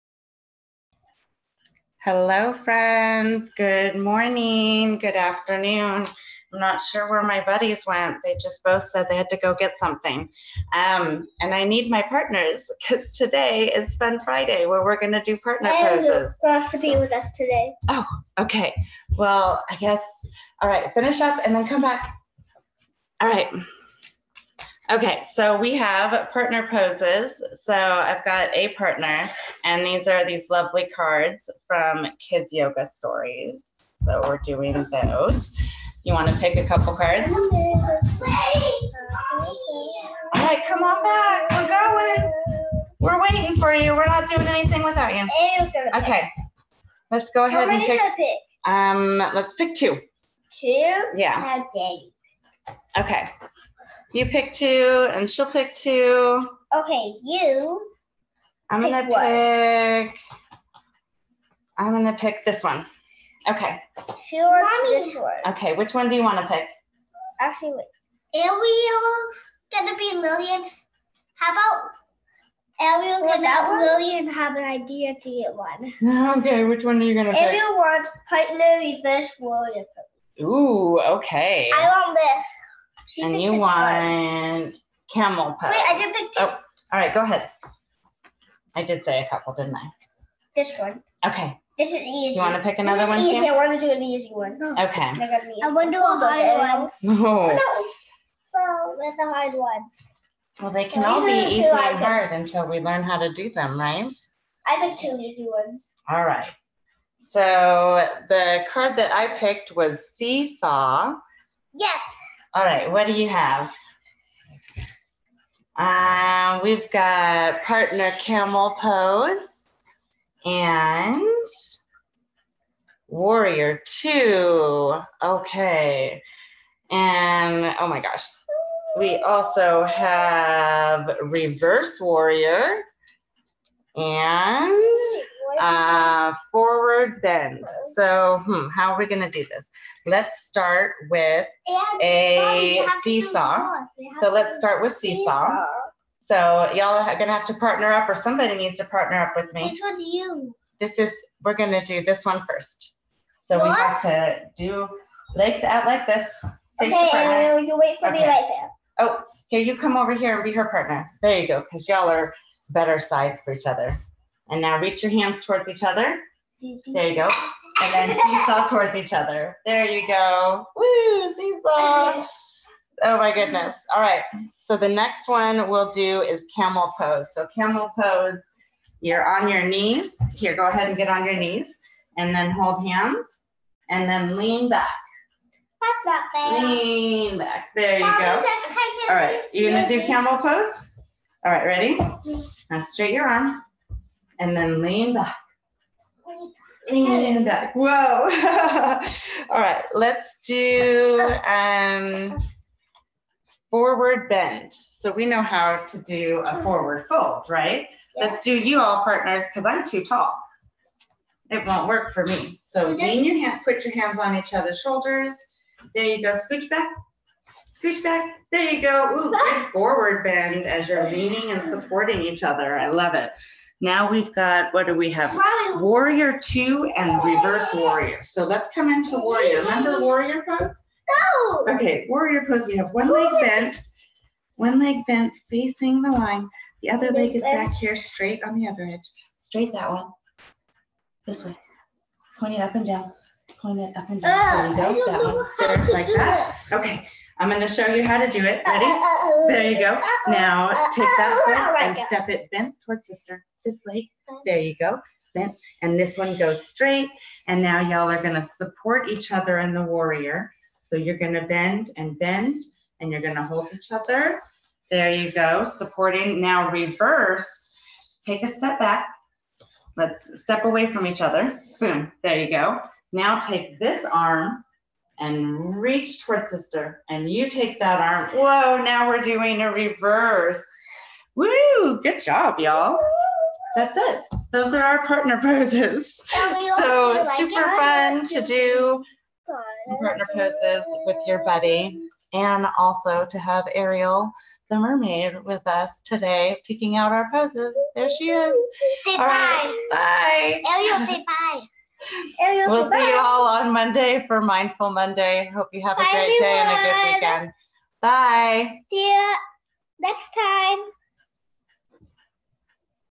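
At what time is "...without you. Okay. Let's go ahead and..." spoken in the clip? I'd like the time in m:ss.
0:44.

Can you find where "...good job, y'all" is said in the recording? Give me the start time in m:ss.
4:42.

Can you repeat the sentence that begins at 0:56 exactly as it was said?
Okay, you I'm pick gonna what?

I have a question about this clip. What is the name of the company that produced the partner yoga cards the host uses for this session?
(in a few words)
Kids Yoga Stories.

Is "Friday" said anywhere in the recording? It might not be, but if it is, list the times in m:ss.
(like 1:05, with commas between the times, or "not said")
0:14.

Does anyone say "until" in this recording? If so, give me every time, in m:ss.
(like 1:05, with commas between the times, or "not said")
1:42.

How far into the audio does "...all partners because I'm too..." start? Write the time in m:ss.
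3:28.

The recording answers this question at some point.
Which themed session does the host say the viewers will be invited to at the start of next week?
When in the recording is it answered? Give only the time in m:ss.
5:04.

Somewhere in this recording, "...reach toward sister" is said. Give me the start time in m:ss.
4:35.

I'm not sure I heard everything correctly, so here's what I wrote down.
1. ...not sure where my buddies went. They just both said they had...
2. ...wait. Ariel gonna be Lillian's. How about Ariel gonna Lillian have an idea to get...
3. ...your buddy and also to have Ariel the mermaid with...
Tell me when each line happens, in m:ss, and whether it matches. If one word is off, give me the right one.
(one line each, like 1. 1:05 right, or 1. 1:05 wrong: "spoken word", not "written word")
1. 0:06 right
2. 1:07 right
3. 4:51 right.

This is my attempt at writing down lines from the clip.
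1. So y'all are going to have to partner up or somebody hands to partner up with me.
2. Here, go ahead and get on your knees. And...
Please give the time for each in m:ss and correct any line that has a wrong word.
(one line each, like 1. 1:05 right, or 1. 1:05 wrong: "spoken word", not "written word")
1. 2:26 wrong: "needs", not "hands"
2. 3:00 right.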